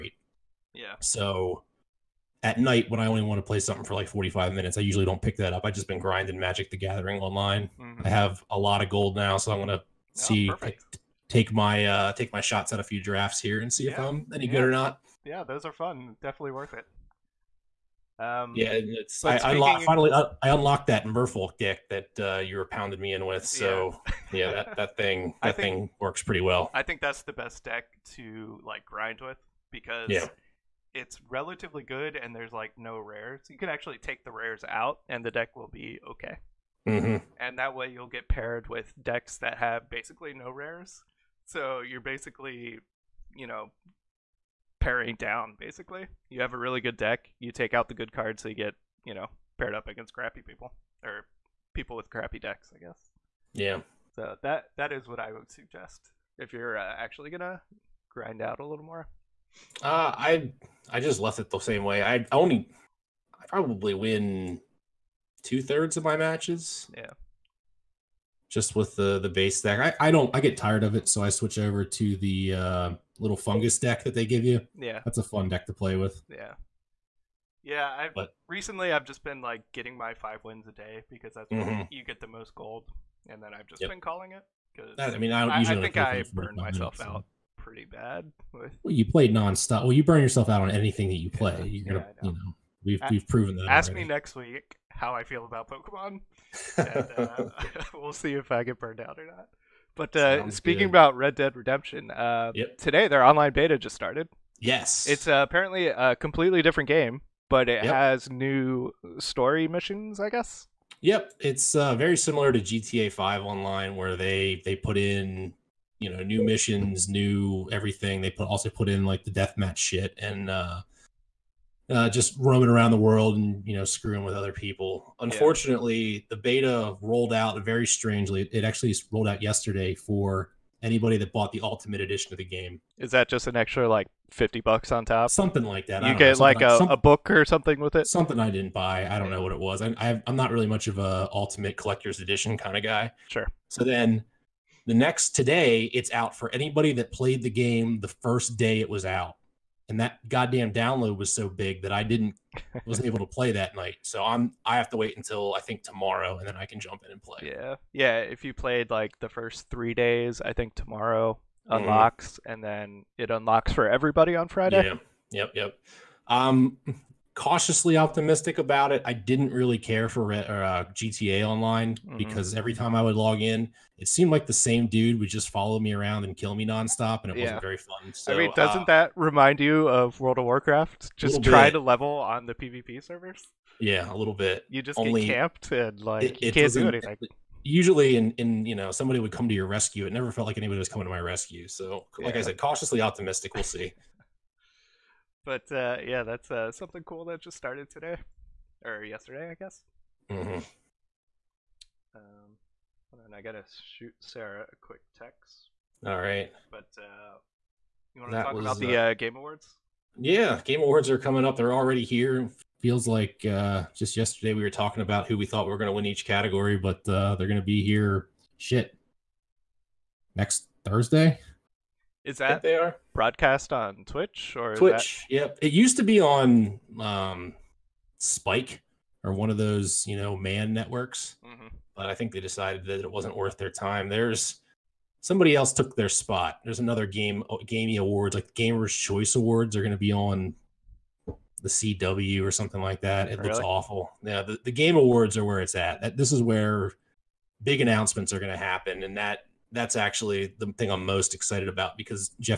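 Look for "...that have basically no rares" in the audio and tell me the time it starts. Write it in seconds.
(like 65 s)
39 s.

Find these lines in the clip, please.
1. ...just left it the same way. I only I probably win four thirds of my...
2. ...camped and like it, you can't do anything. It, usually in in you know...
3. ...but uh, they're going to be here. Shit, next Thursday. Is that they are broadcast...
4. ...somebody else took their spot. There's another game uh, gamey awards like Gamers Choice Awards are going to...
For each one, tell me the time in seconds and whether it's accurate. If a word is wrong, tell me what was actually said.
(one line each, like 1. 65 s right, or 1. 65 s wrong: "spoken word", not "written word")
1. 60 s wrong: "two", not "four"
2. 185 s right
3. 216 s right
4. 235 s right.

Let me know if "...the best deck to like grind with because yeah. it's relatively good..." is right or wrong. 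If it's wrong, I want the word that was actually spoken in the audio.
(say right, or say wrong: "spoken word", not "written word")
right.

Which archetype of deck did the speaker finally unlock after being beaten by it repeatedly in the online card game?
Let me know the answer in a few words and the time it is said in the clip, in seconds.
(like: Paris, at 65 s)
Merfolk, at 21 s.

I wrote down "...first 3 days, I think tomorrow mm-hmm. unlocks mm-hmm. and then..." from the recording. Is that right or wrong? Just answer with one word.
right.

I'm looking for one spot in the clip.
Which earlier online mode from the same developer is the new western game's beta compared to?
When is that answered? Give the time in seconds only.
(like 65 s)
112 s.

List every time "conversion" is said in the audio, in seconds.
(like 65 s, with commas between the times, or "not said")
not said.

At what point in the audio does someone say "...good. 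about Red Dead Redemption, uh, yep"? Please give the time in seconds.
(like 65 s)
100 s.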